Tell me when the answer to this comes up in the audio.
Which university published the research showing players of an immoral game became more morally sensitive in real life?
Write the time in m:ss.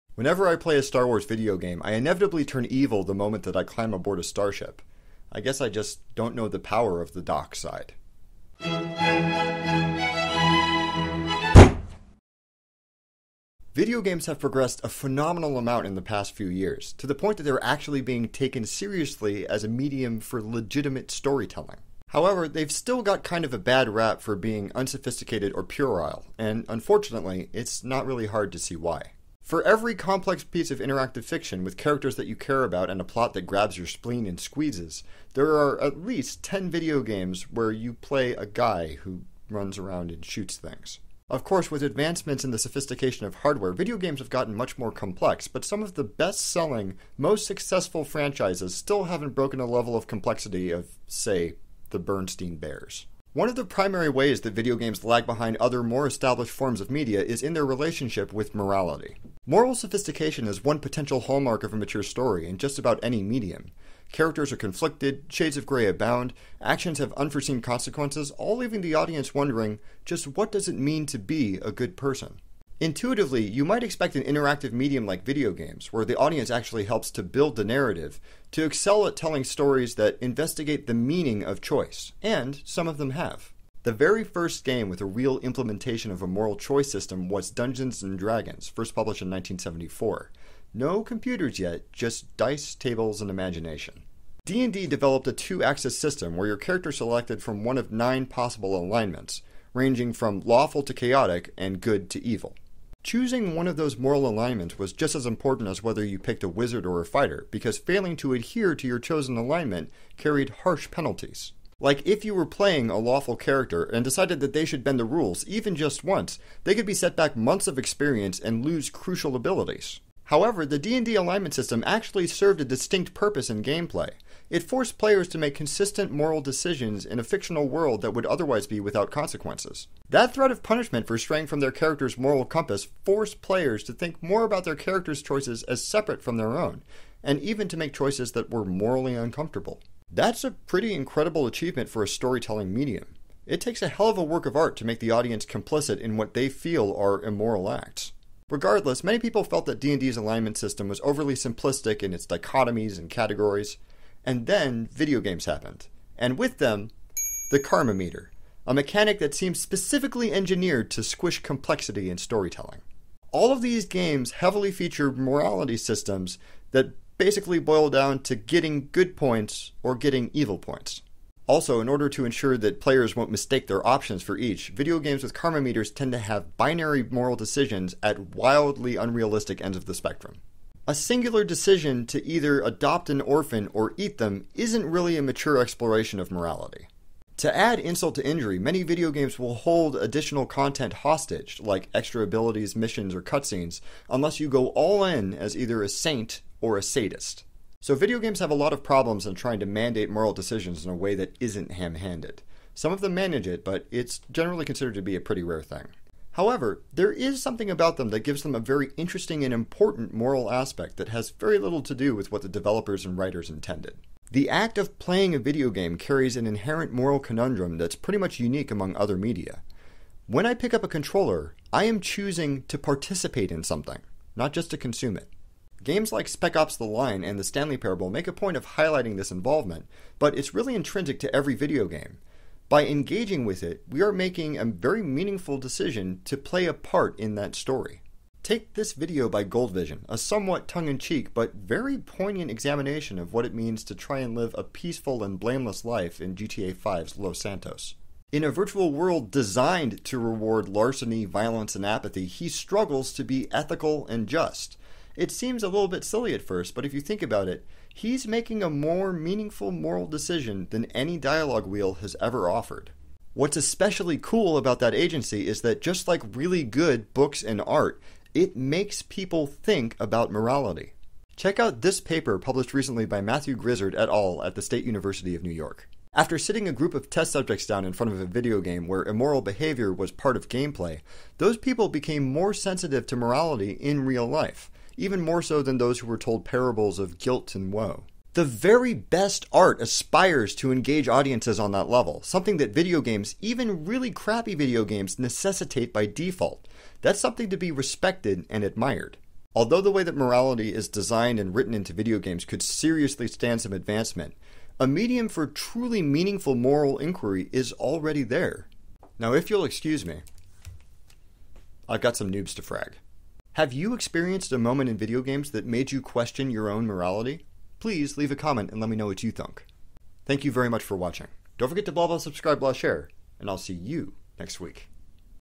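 4:34.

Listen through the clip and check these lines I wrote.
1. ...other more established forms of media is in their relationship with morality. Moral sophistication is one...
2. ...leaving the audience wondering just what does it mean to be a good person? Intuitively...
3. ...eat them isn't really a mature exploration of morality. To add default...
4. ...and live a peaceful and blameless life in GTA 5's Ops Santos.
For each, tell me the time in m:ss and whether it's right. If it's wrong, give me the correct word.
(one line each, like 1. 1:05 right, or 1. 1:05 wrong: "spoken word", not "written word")
1. 0:55 right
2. 1:08 right
3. 3:03 wrong: "insult", not "default"
4. 4:04 wrong: "Los", not "Ops".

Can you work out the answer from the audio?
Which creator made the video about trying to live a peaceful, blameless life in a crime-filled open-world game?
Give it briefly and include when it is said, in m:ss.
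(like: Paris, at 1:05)
Goldvision, at 3:59.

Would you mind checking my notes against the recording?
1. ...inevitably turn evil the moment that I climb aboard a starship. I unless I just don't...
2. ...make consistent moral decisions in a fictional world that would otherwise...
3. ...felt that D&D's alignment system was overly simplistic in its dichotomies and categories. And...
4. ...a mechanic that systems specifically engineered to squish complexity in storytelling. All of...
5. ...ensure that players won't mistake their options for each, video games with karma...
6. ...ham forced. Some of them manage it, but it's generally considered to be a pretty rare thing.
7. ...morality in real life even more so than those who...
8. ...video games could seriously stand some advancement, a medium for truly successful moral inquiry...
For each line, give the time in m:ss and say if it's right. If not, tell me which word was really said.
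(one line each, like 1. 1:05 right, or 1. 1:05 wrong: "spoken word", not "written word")
1. 0:01 wrong: "guess", not "unless"
2. 2:05 right
3. 2:29 right
4. 2:38 wrong: "seems", not "systems"
5. 2:52 right
6. 3:21 wrong: "handed", not "forced"
7. 4:43 right
8. 5:01 wrong: "meaningful", not "successful".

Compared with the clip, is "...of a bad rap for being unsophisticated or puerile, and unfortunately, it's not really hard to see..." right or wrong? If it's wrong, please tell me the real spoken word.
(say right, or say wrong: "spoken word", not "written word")
right.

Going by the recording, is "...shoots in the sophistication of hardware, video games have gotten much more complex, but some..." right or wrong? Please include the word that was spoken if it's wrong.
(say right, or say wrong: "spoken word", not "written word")
wrong: "advancements", not "shoots".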